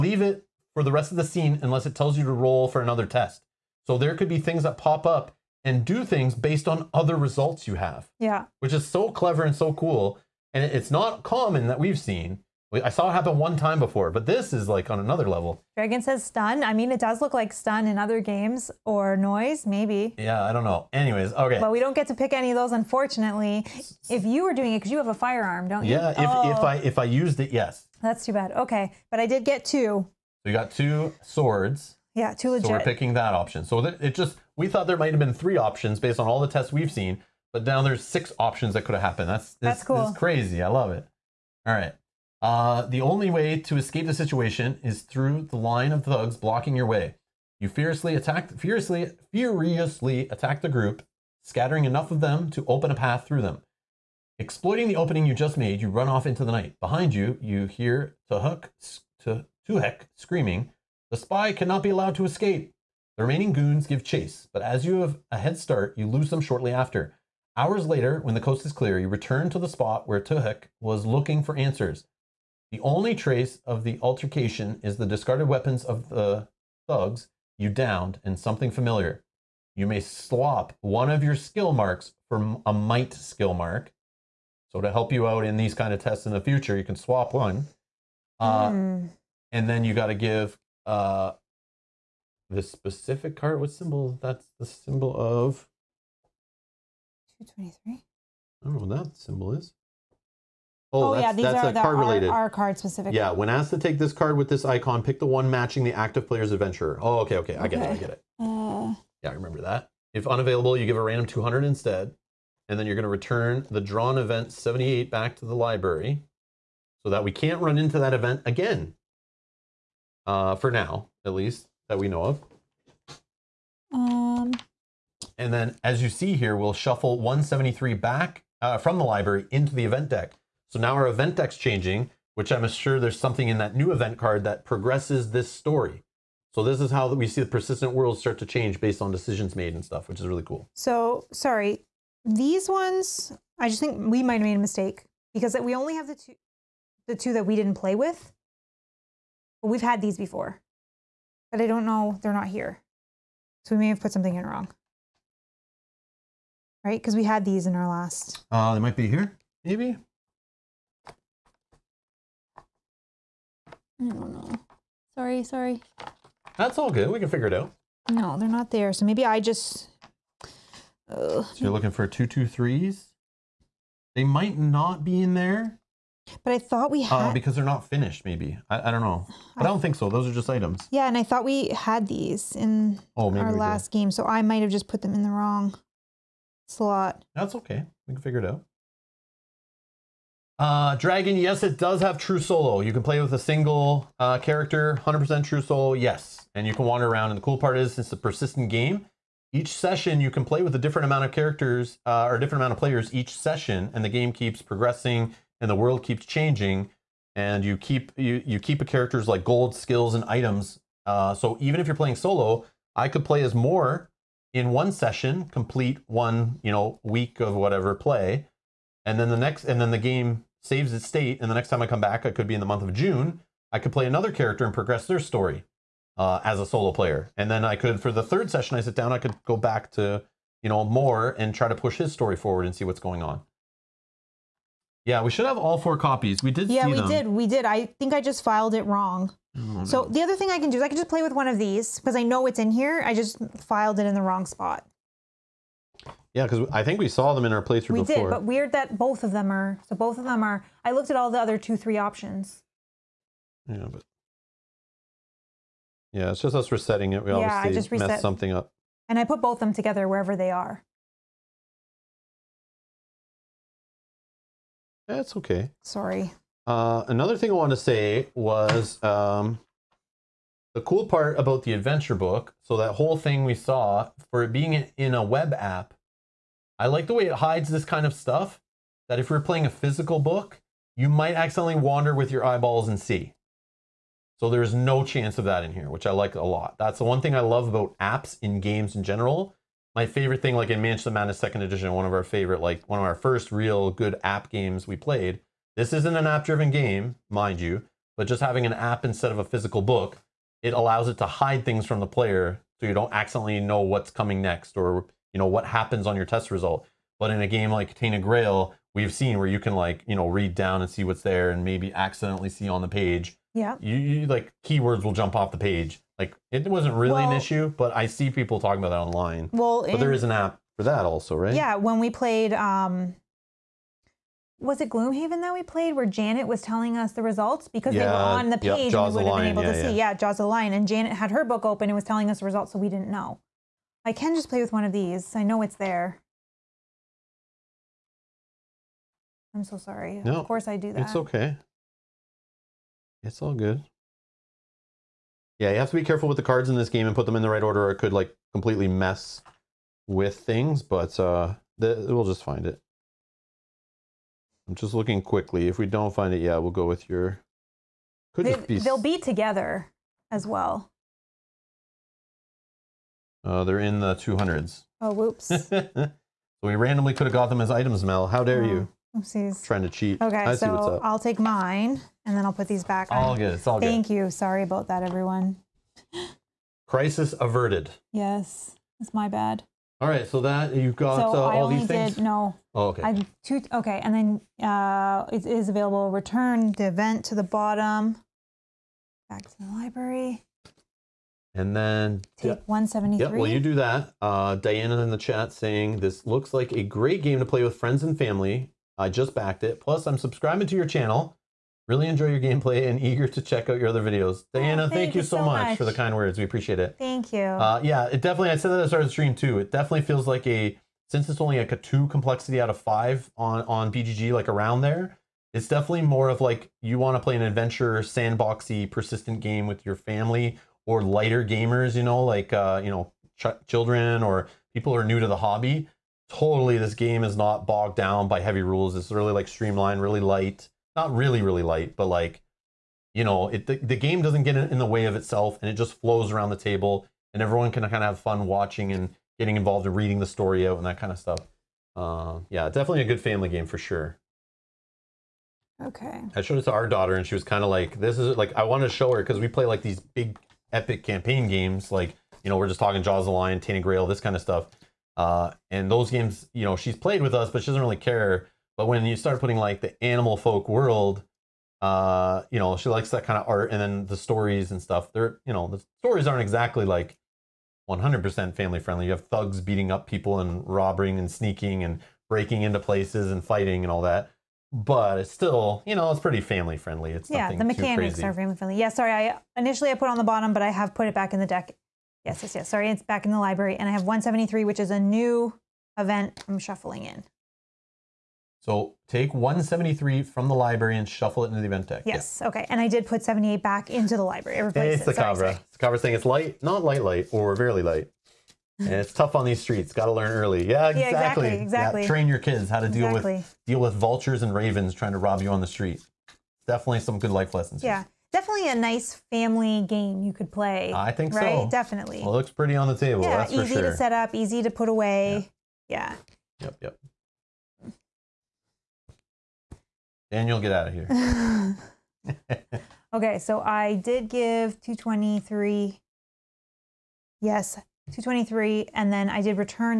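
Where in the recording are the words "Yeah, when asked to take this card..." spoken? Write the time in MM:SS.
01:43.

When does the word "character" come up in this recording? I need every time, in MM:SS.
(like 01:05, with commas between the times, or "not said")
03:14, 03:21, 03:28, 03:44.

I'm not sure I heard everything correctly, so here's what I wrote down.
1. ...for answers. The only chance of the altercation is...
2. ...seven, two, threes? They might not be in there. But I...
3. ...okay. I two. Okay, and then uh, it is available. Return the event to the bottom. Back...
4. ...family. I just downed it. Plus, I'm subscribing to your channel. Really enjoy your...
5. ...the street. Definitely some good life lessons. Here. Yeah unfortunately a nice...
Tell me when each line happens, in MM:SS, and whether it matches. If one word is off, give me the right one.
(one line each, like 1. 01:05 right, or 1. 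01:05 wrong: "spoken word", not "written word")
1. 01:11 wrong: "trace", not "chance"
2. 02:52 wrong: "two", not "seven"
3. 06:22 right
4. 06:38 wrong: "backed", not "downed"
5. 08:25 wrong: "definitely", not "unfortunately".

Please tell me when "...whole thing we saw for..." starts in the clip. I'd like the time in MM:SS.
04:32.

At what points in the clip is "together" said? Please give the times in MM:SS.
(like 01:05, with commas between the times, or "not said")
04:19, 05:59.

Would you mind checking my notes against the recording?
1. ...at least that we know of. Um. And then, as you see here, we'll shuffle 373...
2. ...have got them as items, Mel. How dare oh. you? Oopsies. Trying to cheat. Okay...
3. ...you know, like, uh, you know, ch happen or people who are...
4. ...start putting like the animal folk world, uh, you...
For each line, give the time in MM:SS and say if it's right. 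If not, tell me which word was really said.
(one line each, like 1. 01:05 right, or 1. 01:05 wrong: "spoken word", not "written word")
1. 02:01 wrong: "173", not "373"
2. 06:07 right
3. 07:01 wrong: "children", not "happen"
4. 07:39 right.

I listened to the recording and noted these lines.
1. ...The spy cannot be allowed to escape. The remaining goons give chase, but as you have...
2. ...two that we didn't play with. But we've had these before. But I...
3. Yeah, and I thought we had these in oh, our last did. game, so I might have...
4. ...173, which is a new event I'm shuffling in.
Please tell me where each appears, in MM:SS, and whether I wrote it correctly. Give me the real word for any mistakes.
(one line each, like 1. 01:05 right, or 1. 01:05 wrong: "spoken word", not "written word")
1. 01:01 right
2. 02:27 right
3. 03:00 right
4. 08:04 right.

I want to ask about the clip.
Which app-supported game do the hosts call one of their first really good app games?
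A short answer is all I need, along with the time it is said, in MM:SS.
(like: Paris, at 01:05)
Mansion of Madness Second Edition, at 04:50.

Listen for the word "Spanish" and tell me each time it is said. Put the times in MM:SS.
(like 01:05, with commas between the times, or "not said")
not said.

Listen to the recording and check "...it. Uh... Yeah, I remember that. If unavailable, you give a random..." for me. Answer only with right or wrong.
right.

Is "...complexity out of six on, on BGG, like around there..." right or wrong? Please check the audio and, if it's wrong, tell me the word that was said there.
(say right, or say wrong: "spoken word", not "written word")
wrong: "five", not "six".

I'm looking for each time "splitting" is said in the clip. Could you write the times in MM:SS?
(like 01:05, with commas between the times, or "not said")
not said.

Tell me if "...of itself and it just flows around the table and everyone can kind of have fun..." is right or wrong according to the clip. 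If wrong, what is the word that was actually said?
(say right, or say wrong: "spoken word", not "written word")
right.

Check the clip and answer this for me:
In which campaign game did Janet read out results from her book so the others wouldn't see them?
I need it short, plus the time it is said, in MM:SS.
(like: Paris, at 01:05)
Jaws of Lion, at 05:30.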